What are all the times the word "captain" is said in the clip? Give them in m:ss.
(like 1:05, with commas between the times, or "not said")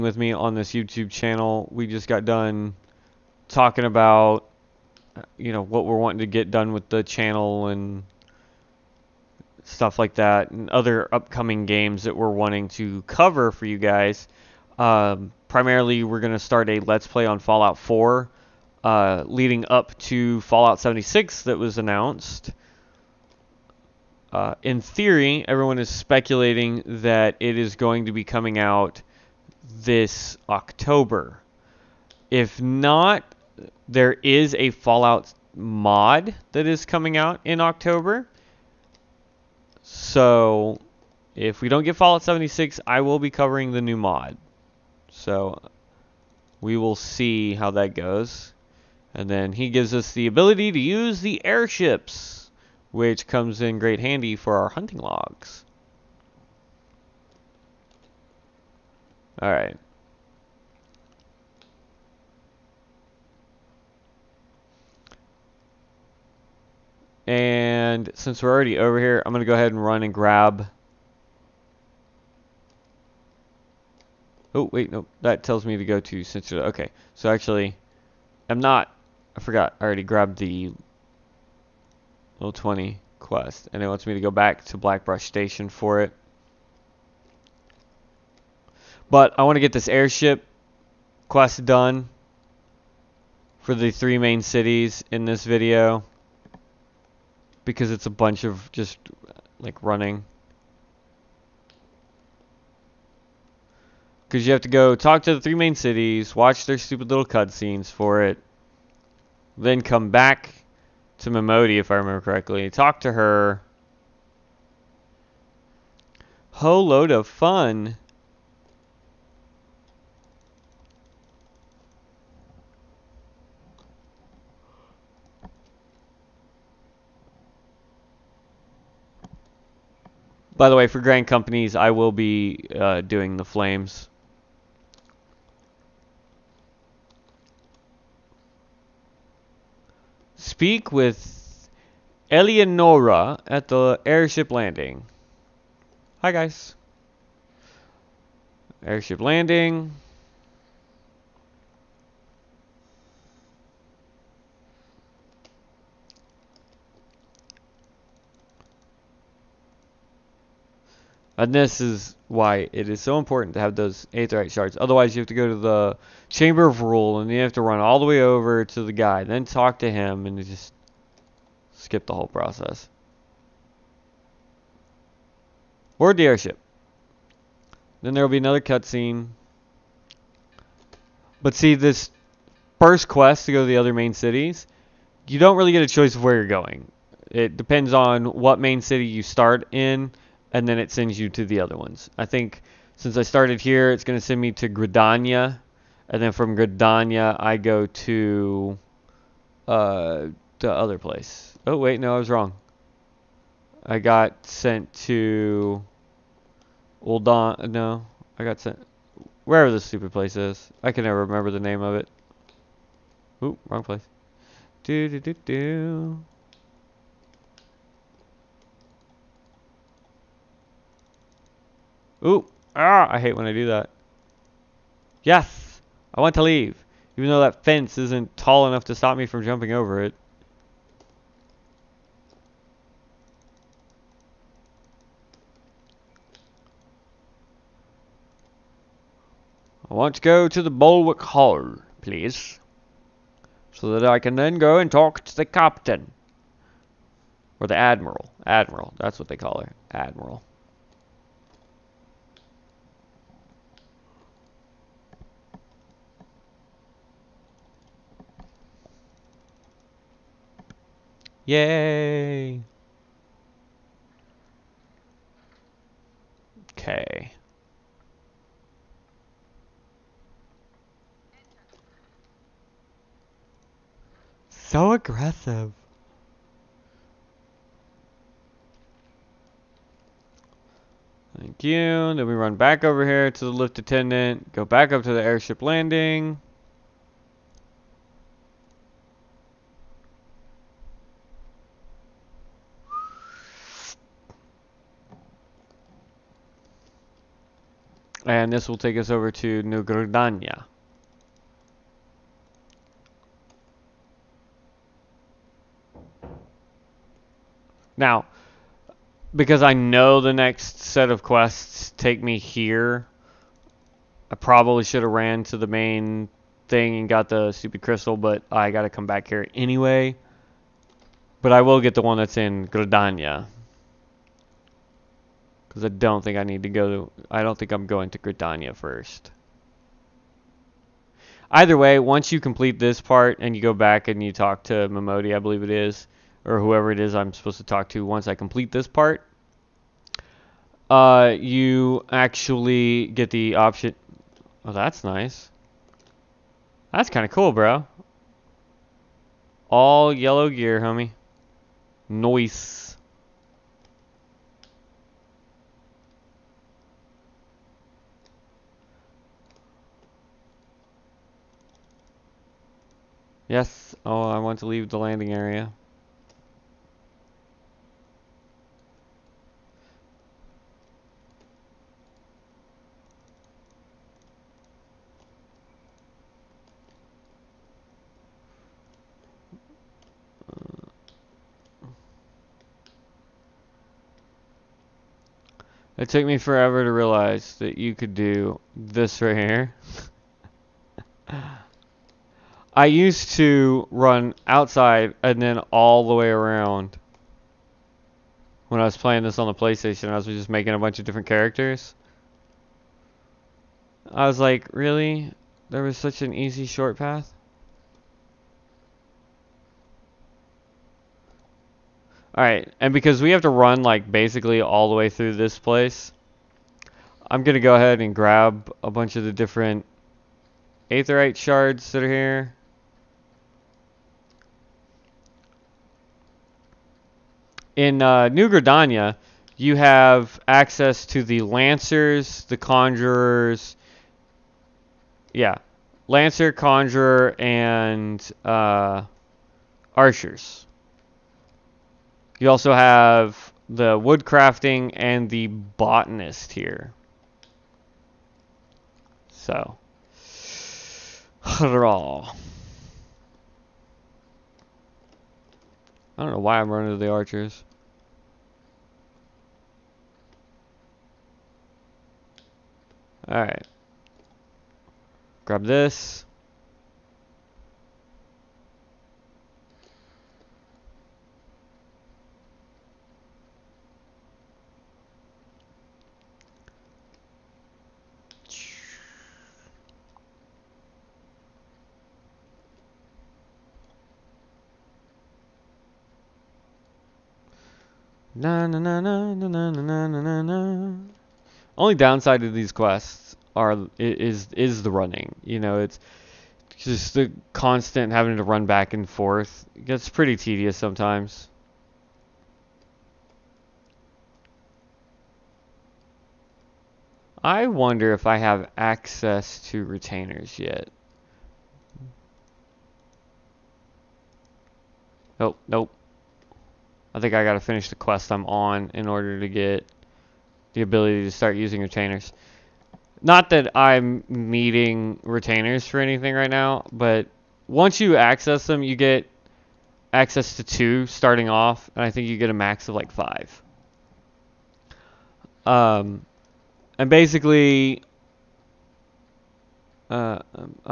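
4:05.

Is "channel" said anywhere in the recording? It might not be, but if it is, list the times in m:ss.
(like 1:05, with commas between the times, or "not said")
0:01, 0:07.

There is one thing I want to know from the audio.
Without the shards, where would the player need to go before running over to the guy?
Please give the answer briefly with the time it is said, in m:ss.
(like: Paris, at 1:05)
Chamber of Rule, at 2:46.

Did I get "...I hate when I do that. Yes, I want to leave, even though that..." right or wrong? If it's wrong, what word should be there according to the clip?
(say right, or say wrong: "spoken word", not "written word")
right.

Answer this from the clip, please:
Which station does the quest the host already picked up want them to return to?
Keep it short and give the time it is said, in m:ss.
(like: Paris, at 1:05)
Blackbrush Station, at 1:24.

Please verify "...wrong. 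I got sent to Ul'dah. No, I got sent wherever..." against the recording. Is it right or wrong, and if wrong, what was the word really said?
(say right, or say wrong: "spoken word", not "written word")
right.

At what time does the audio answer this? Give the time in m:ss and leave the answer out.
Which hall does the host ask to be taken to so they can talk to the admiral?
4:00.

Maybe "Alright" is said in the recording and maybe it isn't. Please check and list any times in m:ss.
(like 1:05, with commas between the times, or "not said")
6:52, 7:43.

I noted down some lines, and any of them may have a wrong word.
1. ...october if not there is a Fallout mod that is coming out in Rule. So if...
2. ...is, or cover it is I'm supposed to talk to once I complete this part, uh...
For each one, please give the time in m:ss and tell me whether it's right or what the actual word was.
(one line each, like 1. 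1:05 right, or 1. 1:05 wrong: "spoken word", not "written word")
1. 0:30 wrong: "October", not "Rule"
2. 5:35 wrong: "whoever", not "cover".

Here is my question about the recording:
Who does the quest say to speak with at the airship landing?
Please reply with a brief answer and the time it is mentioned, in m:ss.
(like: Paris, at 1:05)
Eleonora, at 2:22.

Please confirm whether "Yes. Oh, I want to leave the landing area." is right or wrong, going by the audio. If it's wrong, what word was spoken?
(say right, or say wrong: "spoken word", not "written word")
right.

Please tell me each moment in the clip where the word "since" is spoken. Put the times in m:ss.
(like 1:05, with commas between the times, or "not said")
1:08, 3:12.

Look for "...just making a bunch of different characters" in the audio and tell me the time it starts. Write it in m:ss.
6:40.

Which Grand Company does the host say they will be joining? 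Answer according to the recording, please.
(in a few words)
the Flames.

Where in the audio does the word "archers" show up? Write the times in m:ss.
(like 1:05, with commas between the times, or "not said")
7:19, 7:37.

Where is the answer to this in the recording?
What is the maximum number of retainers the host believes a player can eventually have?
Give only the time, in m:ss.
8:53.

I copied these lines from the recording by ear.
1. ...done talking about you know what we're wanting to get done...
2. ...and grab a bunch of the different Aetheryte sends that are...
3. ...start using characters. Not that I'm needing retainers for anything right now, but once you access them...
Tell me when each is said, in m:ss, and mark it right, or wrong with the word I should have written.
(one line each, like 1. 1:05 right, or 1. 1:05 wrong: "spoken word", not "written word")
1. 0:02 right
2. 6:57 wrong: "shards", not "sends"
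3. 8:41 wrong: "retainers", not "characters".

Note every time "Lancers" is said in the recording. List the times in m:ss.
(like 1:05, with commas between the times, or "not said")
7:11, 7:16.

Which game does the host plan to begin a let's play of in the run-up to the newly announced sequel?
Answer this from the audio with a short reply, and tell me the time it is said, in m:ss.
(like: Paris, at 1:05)
Fallout 4, at 0:17.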